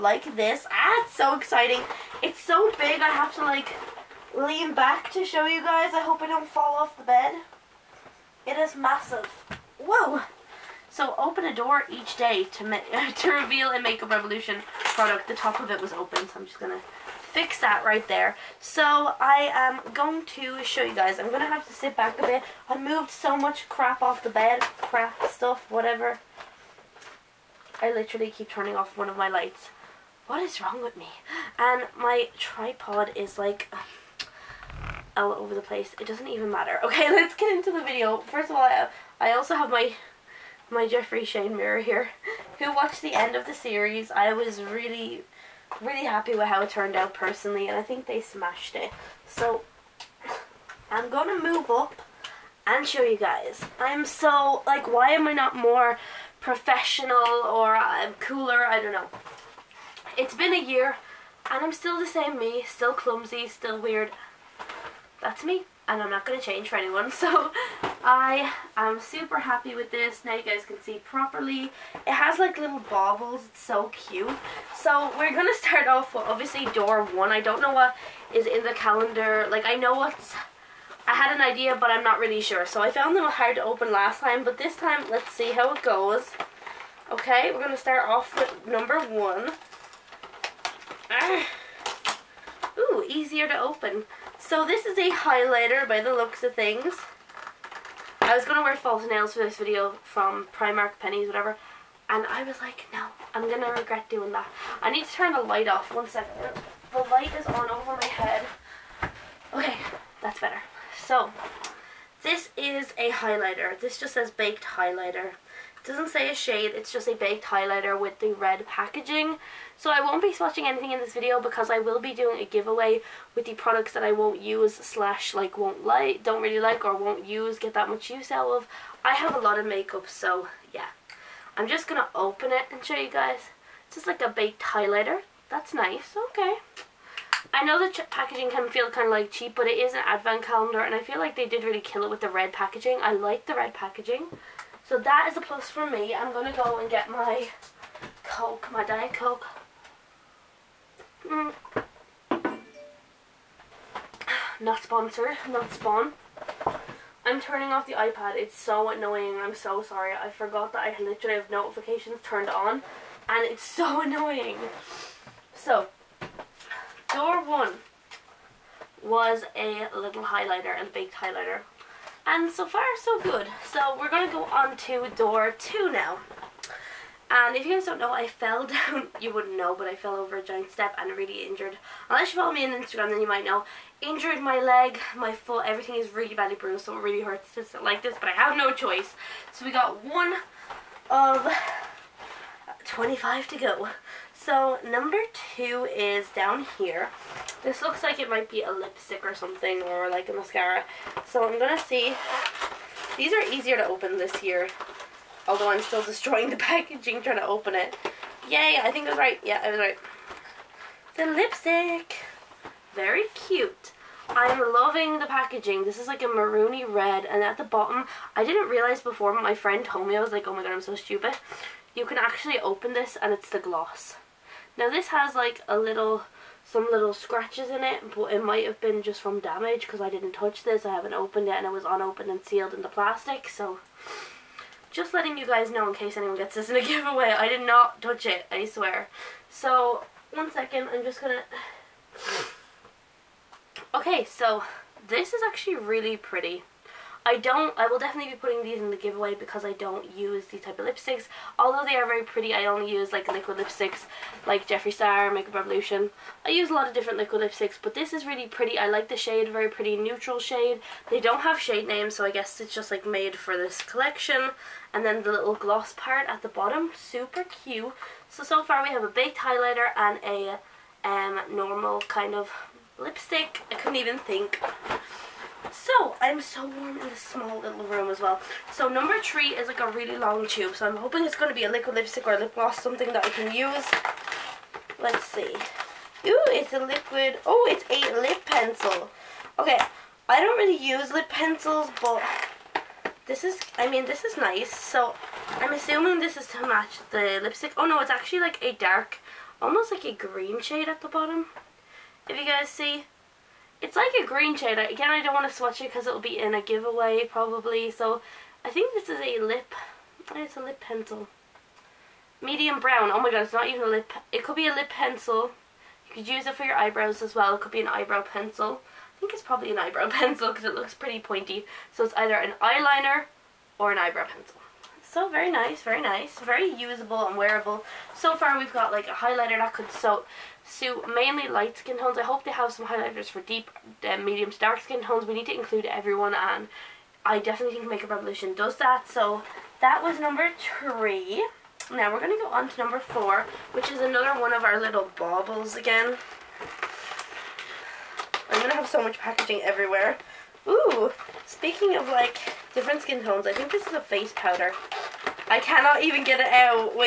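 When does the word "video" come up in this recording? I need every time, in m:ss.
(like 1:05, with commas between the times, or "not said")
0:37, 1:39, 2:01.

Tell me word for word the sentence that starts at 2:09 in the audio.
I have a lot of makeup so yeah.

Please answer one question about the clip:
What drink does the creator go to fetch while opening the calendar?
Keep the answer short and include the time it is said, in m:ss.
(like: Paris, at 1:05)
Diet Coke, at 2:28.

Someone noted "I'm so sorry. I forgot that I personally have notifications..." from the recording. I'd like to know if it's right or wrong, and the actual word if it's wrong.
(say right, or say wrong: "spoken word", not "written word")
wrong: "literally", not "personally".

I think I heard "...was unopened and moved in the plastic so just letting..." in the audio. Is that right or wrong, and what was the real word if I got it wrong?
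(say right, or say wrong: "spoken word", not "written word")
wrong: "sealed", not "moved".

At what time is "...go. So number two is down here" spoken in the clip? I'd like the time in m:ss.
3:13.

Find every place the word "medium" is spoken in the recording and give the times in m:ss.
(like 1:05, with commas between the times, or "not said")
5:12, 5:34.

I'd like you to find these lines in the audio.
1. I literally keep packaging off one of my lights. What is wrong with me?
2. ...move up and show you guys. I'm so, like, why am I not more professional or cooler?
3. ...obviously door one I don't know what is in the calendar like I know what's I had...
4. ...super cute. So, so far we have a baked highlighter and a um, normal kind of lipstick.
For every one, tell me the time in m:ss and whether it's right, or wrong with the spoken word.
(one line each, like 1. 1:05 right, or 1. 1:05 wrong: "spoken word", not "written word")
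1. 0:27 wrong: "turning", not "packaging"
2. 0:51 right
3. 1:16 right
4. 4:26 right.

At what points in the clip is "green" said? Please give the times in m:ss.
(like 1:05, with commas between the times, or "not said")
5:00, 5:04.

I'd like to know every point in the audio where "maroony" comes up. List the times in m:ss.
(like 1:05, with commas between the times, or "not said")
3:36.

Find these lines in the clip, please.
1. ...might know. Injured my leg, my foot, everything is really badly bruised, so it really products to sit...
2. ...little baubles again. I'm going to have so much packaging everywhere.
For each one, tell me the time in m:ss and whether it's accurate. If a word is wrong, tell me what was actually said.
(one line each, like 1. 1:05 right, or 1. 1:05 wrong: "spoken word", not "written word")
1. 3:03 wrong: "hurts", not "products"
2. 5:44 right.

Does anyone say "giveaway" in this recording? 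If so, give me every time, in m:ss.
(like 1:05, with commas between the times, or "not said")
2:02, 3:56, 4:08, 5:06.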